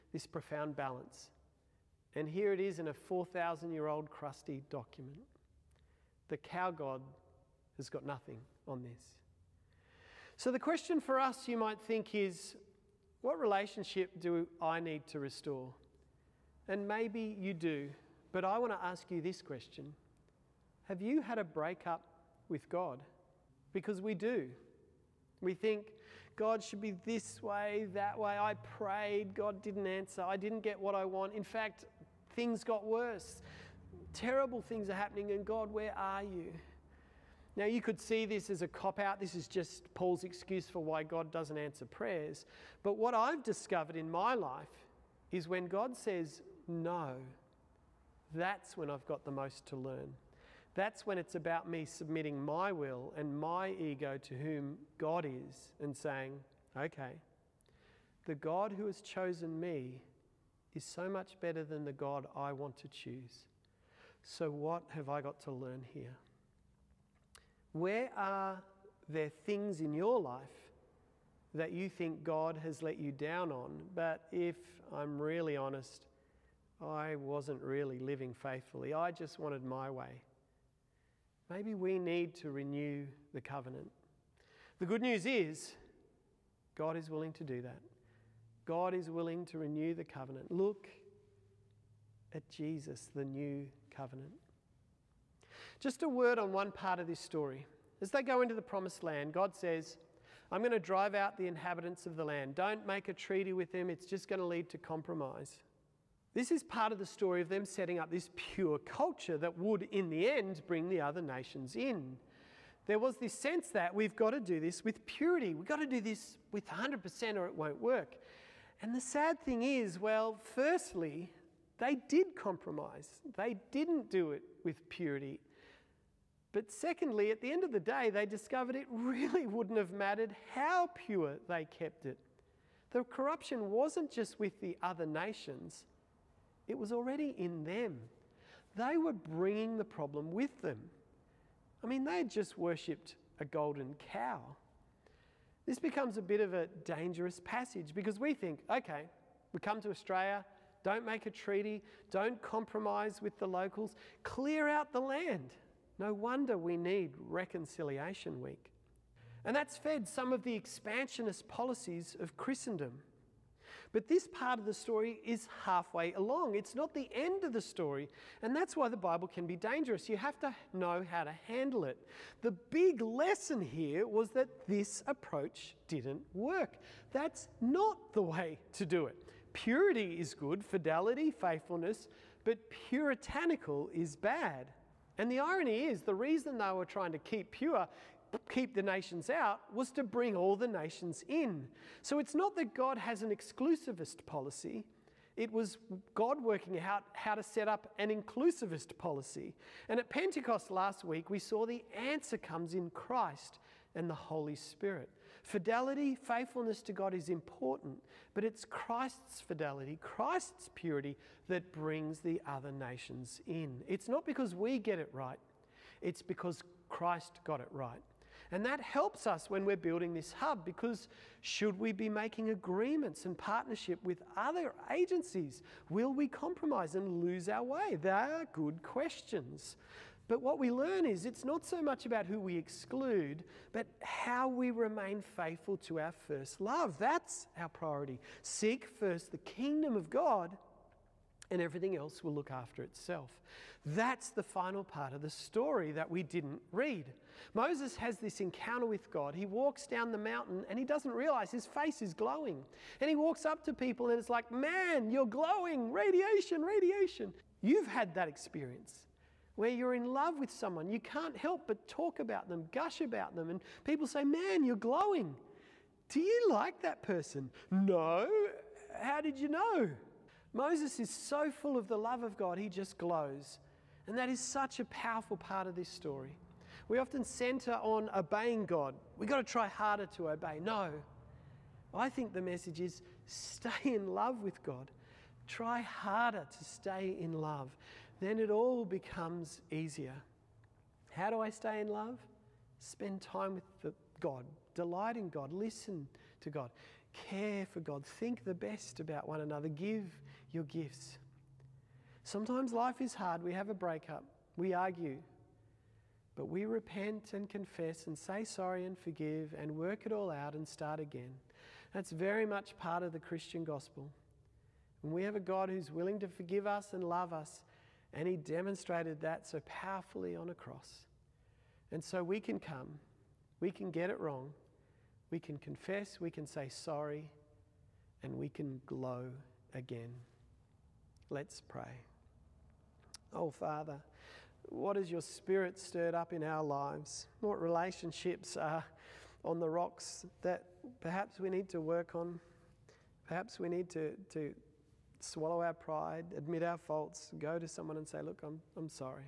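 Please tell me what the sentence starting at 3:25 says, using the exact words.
Fidelity, faithfulness to God is important, but it's Christ's fidelity, Christ's purity that brings the other nations in.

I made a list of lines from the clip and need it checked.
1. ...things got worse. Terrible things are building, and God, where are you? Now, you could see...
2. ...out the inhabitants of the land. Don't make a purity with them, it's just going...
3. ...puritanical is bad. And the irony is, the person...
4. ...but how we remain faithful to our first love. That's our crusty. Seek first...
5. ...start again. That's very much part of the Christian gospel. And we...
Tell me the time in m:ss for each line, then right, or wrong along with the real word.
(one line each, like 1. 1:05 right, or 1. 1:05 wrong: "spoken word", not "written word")
1. 0:32 wrong: "happening", not "building"
2. 1:41 wrong: "treaty", not "purity"
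3. 3:02 wrong: "reason", not "person"
4. 3:53 wrong: "priority", not "crusty"
5. 5:10 right.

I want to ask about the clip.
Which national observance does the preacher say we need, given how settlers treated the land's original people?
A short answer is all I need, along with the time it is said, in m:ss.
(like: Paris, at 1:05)
Reconciliation Week, at 2:37.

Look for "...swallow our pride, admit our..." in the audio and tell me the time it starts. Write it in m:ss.
5:45.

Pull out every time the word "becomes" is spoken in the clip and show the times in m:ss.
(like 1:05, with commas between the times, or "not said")
2:25, 4:48.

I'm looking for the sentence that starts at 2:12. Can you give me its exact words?
The corruption wasn't just with the other nations it was already in them.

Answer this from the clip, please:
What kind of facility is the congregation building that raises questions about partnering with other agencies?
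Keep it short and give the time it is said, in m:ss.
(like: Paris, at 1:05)
hub, at 3:40.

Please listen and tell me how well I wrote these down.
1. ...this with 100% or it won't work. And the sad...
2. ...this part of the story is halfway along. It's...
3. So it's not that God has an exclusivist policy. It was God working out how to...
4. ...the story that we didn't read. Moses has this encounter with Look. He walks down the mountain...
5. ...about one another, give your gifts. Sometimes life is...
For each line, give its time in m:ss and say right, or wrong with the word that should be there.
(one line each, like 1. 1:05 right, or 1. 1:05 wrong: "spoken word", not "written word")
1. 1:56 right
2. 2:44 right
3. 3:12 right
4. 4:05 wrong: "God", not "Look"
5. 4:58 right.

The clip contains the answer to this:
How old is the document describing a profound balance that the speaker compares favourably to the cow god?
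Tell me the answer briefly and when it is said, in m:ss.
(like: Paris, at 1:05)
4,000 years, at 0:02.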